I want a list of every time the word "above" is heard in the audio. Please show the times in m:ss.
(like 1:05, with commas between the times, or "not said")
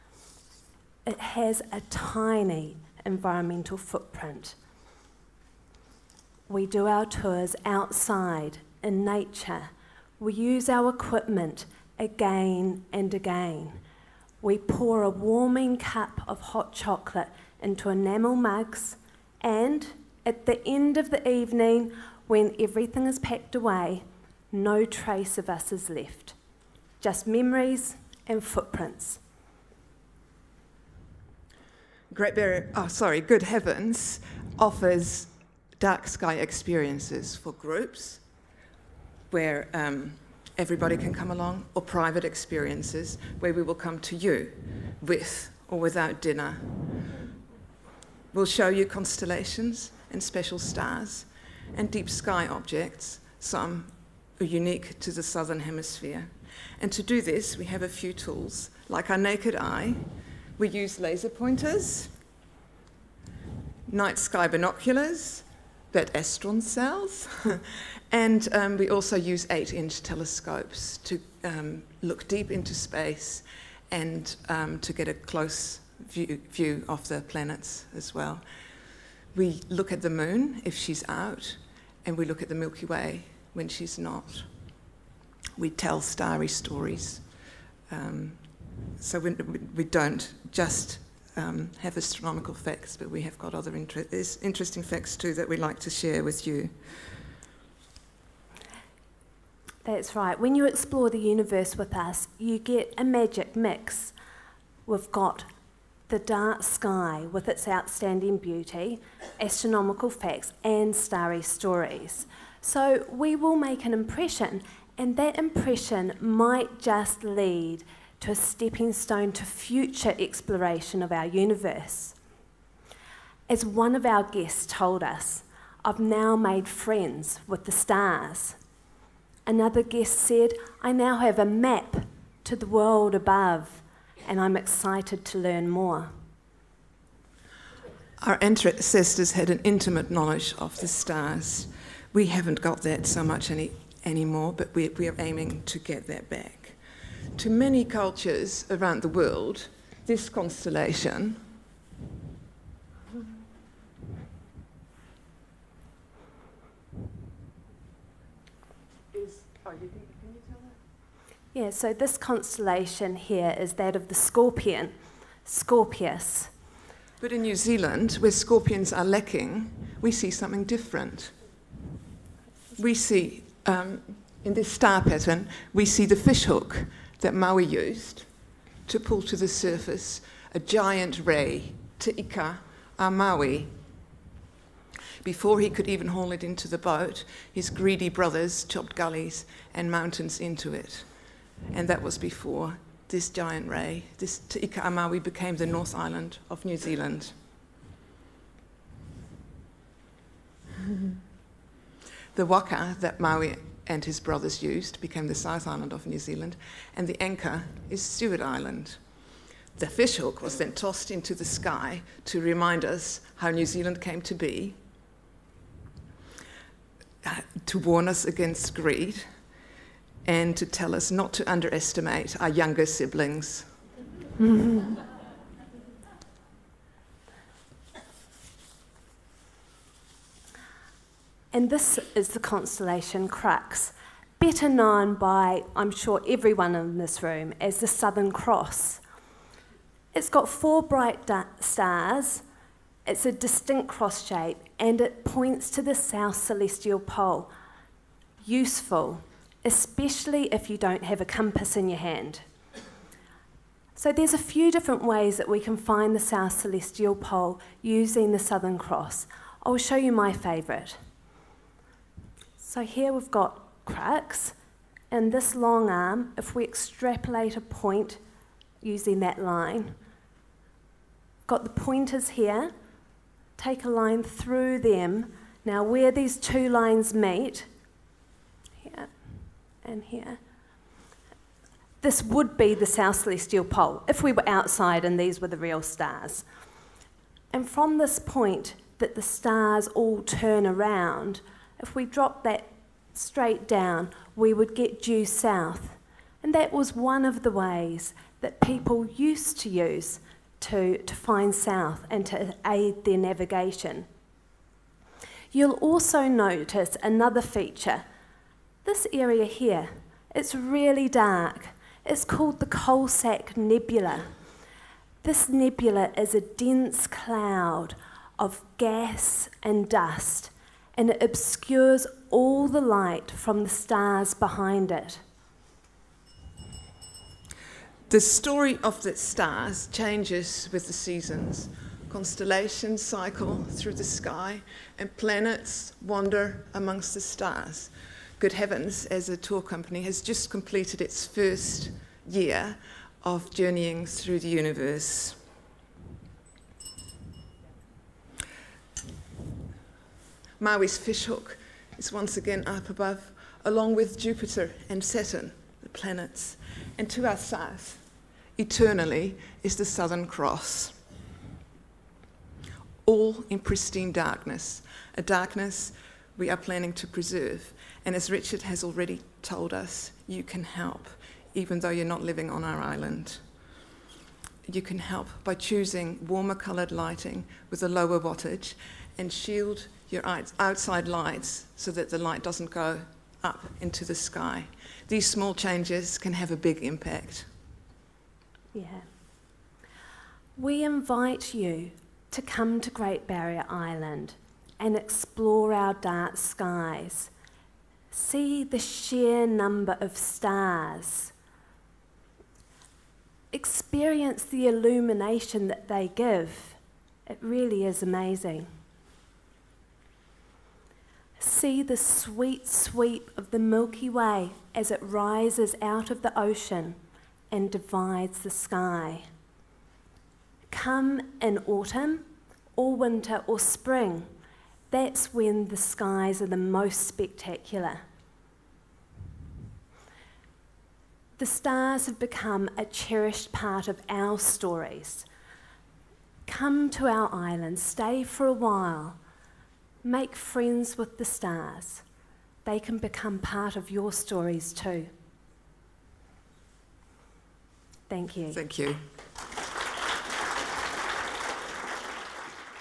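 2:13, 5:52.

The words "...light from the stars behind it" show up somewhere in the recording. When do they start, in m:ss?
5:22.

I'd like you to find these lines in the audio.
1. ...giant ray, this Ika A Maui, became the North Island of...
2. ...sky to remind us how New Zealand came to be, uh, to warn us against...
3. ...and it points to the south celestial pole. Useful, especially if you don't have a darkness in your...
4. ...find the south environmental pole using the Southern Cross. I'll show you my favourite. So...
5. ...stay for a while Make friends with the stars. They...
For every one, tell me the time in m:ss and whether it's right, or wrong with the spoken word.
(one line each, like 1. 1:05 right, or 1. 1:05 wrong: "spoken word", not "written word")
1. 3:13 right
2. 3:31 right
3. 4:04 wrong: "compass", not "darkness"
4. 4:15 wrong: "celestial", not "environmental"
5. 7:17 right.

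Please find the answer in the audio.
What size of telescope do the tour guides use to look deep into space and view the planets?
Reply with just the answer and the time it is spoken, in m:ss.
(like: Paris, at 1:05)
8 inch, at 1:09.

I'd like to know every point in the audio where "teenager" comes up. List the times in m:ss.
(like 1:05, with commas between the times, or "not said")
not said.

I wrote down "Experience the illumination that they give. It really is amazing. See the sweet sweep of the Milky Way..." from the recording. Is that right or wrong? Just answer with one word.
right.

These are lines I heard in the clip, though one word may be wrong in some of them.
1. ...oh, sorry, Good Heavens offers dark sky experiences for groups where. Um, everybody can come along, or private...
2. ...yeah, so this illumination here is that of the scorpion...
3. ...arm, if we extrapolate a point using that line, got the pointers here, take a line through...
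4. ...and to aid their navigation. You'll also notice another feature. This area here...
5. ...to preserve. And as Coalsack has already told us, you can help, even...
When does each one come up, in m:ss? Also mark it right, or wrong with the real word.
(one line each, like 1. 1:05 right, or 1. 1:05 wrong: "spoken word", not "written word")
1. 0:32 right
2. 2:41 wrong: "constellation", not "illumination"
3. 4:25 right
4. 5:02 right
5. 6:06 wrong: "Richard", not "Coalsack".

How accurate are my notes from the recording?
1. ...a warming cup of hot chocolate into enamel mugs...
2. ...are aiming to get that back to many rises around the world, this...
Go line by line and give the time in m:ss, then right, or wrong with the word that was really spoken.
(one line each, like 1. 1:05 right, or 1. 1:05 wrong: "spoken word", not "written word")
1. 0:15 right
2. 2:25 wrong: "cultures", not "rises".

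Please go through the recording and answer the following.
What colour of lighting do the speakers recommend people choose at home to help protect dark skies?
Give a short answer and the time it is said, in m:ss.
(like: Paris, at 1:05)
warmer coloured, at 6:16.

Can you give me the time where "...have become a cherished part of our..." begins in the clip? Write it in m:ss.
7:12.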